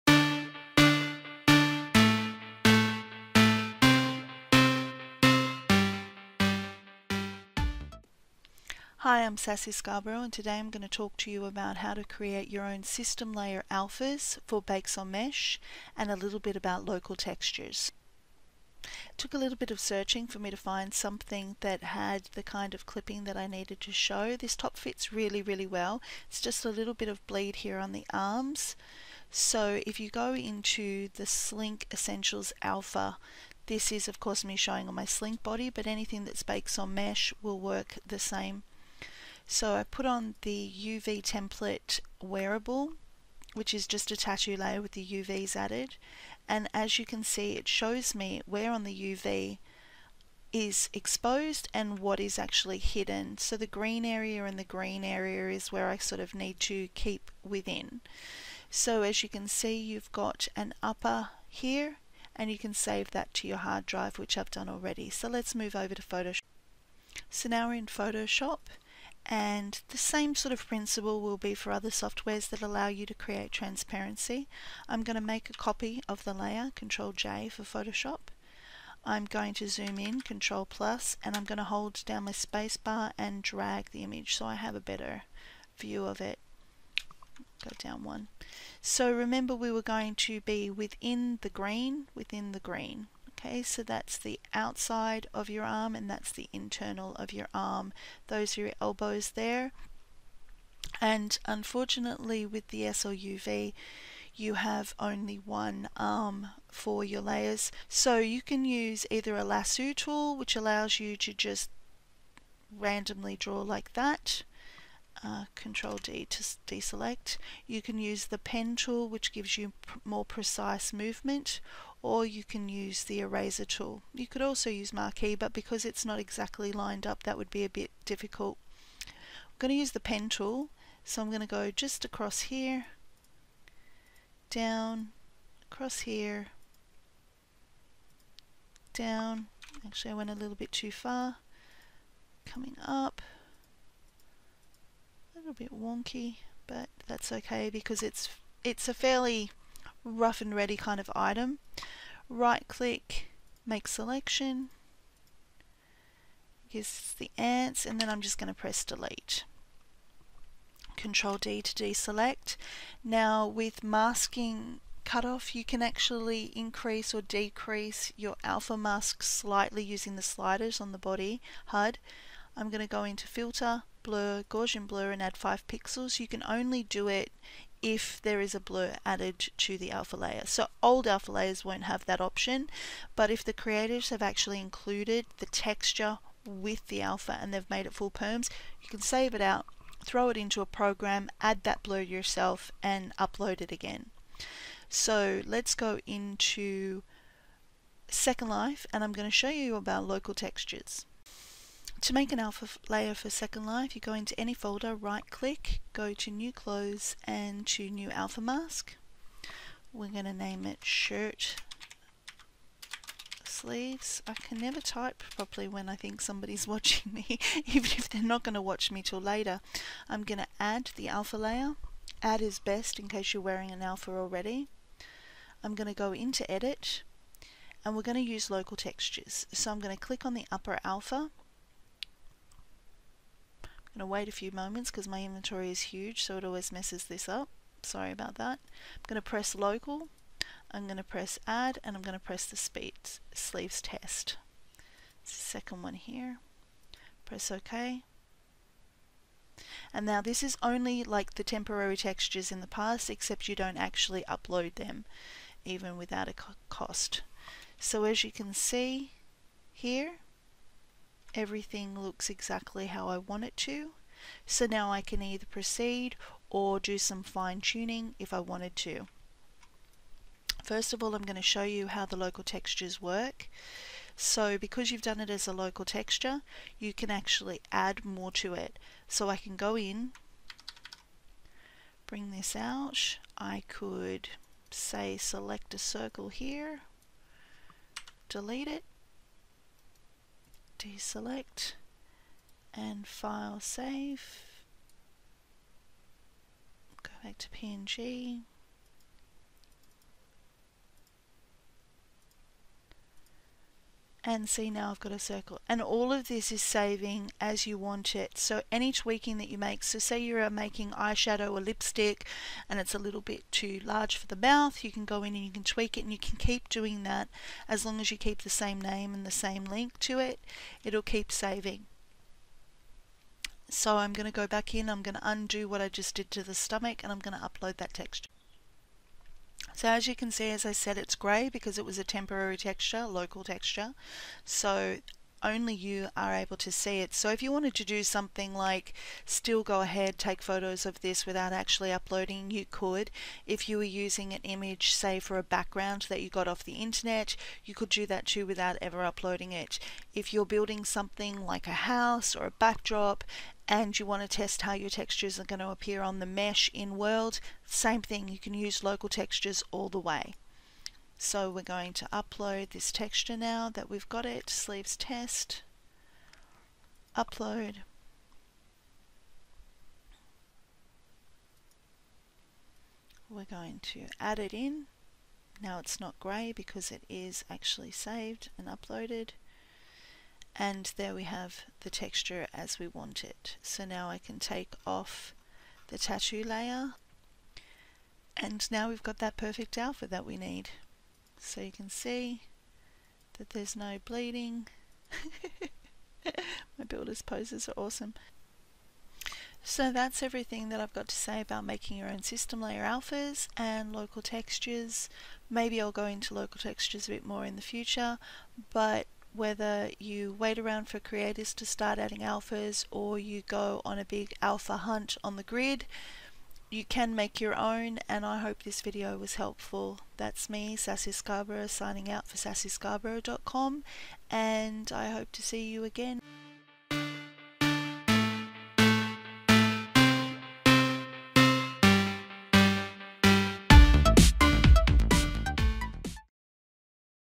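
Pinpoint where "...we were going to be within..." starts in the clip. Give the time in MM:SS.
01:29.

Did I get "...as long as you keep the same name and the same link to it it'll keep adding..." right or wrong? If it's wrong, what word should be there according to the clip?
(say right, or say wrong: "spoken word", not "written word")
wrong: "saving", not "adding".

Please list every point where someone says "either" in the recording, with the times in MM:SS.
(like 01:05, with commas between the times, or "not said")
01:49, 04:25.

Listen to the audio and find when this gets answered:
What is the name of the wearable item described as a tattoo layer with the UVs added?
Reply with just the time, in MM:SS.
00:40.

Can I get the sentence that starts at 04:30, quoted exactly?
First of all, I'm going to show you how the local textures work.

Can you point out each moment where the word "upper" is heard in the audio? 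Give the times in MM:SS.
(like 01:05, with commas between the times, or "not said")
01:00, 03:50.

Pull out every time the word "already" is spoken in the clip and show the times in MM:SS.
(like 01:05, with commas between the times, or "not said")
01:04, 03:44.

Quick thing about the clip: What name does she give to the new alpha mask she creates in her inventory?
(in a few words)
Shirt Sleeves.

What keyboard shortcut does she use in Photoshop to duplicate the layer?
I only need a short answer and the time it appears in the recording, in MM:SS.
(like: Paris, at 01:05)
Control J, at 01:16.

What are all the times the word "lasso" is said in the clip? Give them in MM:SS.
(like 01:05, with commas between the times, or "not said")
01:49.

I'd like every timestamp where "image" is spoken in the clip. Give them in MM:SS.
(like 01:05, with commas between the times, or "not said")
01:24, 05:44.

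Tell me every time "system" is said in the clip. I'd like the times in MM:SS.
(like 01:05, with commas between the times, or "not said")
00:12, 06:42.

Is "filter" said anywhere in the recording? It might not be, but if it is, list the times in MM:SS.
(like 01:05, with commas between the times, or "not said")
02:53.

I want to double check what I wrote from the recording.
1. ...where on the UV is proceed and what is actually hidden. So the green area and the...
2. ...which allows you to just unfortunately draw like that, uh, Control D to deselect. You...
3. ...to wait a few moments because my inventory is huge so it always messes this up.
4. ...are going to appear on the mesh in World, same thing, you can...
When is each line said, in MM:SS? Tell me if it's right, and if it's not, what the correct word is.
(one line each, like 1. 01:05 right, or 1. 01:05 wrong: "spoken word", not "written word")
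1. 00:48 wrong: "exposed", not "proceed"
2. 01:50 wrong: "randomly", not "unfortunately"
3. 03:54 right
4. 05:55 right.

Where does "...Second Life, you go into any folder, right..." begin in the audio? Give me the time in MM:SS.
03:23.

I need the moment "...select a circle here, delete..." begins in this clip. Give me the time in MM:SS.
04:45.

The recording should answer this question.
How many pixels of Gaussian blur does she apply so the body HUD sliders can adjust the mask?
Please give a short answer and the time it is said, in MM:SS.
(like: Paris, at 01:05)
5, at 02:55.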